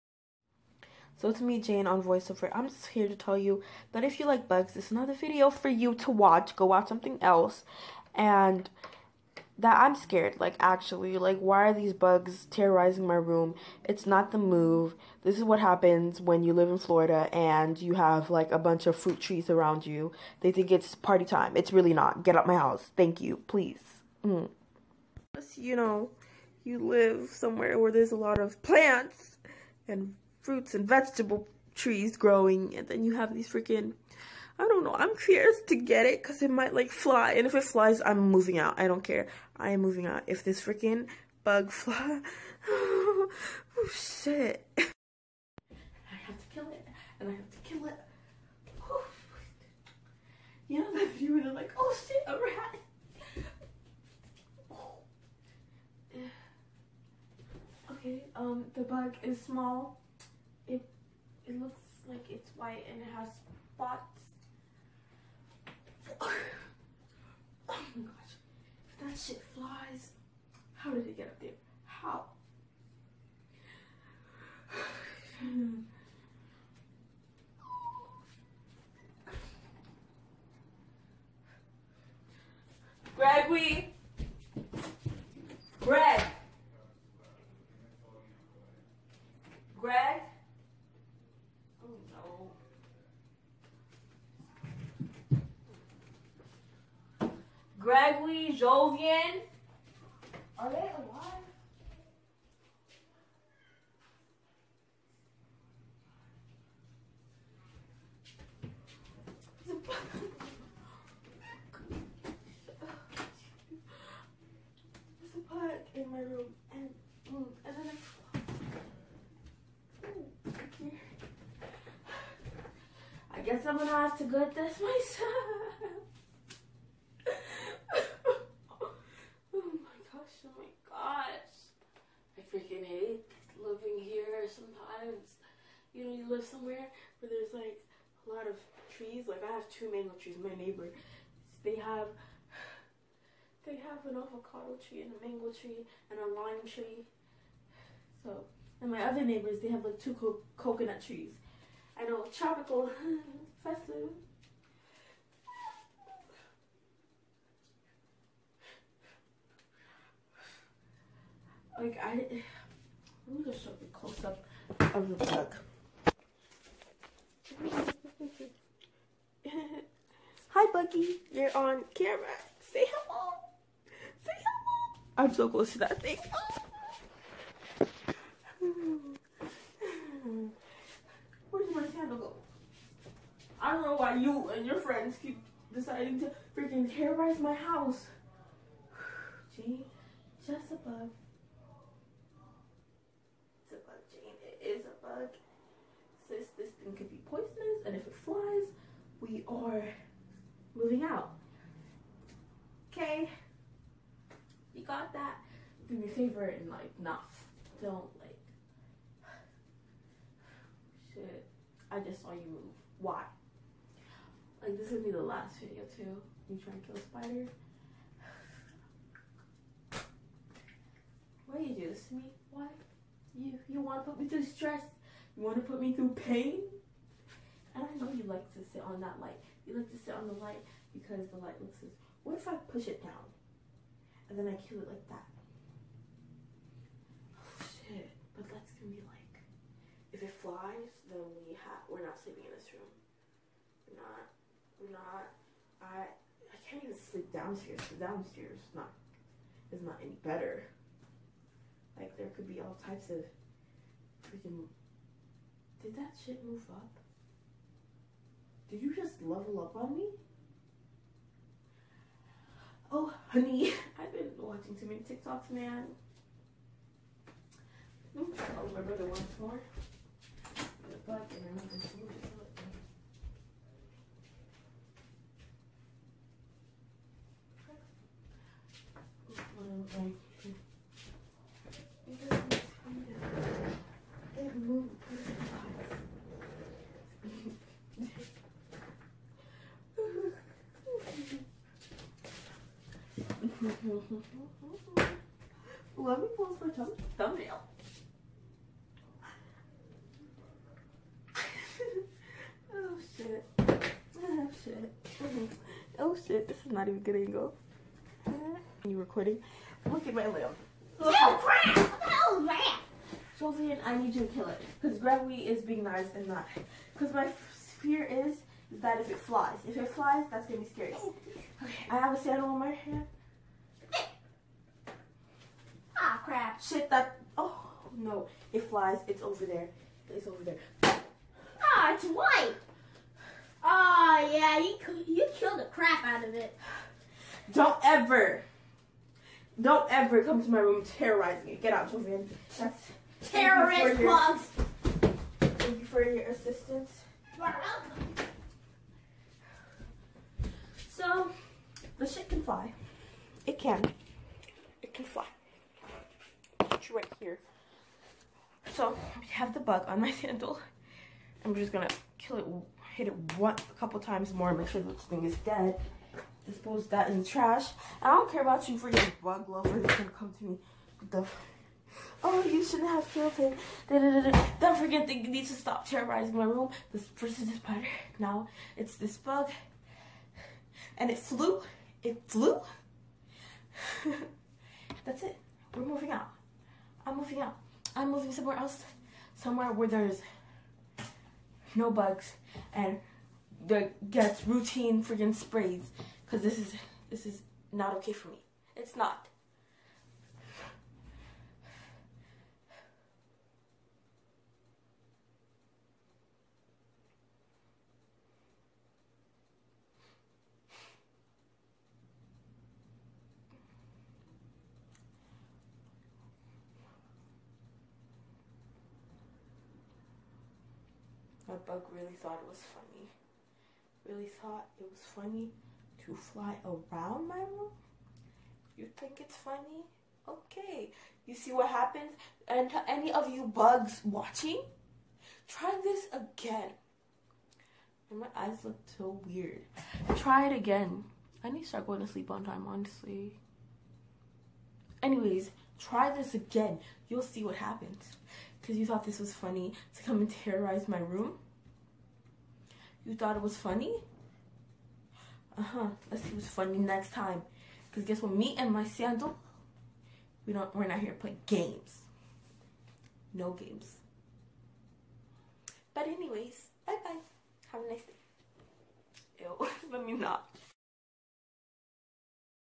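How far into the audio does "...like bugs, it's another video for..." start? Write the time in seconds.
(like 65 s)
4 s.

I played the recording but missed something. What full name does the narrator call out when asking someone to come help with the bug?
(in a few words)
Gregory Jovian.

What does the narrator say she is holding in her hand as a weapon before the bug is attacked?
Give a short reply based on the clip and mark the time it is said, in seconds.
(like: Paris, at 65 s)
A sandal, at 322 s.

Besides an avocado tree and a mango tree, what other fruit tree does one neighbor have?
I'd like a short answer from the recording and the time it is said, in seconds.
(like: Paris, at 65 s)
Lime tree, at 146 s.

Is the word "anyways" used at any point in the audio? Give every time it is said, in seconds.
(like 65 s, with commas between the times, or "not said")
445 s, 466 s.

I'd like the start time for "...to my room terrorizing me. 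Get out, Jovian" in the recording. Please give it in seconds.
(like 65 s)
340 s.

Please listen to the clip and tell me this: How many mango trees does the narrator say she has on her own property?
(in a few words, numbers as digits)
2.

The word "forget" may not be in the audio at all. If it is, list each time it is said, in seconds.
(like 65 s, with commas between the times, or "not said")
374 s.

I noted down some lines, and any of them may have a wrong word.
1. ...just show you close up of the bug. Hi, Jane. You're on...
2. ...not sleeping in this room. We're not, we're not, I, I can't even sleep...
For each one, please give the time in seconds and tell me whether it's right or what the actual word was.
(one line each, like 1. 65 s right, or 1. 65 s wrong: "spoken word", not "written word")
1. 163 s wrong: "Buggy", not "Jane"
2. 242 s right.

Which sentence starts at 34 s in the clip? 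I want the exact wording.
I'm curious to get it because it might like fly.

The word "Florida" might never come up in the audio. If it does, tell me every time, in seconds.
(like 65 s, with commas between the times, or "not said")
16 s.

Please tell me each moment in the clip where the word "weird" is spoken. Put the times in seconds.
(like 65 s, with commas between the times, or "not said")
439 s.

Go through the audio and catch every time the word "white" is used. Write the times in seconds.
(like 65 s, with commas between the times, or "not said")
62 s, 332 s.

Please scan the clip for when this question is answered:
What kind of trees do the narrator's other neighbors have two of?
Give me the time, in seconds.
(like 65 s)
150 s.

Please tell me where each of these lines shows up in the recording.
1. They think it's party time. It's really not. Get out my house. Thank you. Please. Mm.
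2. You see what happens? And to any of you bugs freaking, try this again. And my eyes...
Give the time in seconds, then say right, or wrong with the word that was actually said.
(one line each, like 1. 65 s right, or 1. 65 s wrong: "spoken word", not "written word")
1. 20 s right
2. 431 s wrong: "watching", not "freaking".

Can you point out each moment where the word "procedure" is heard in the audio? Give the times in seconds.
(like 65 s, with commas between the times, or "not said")
not said.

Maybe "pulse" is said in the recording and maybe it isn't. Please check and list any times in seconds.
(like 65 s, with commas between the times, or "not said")
not said.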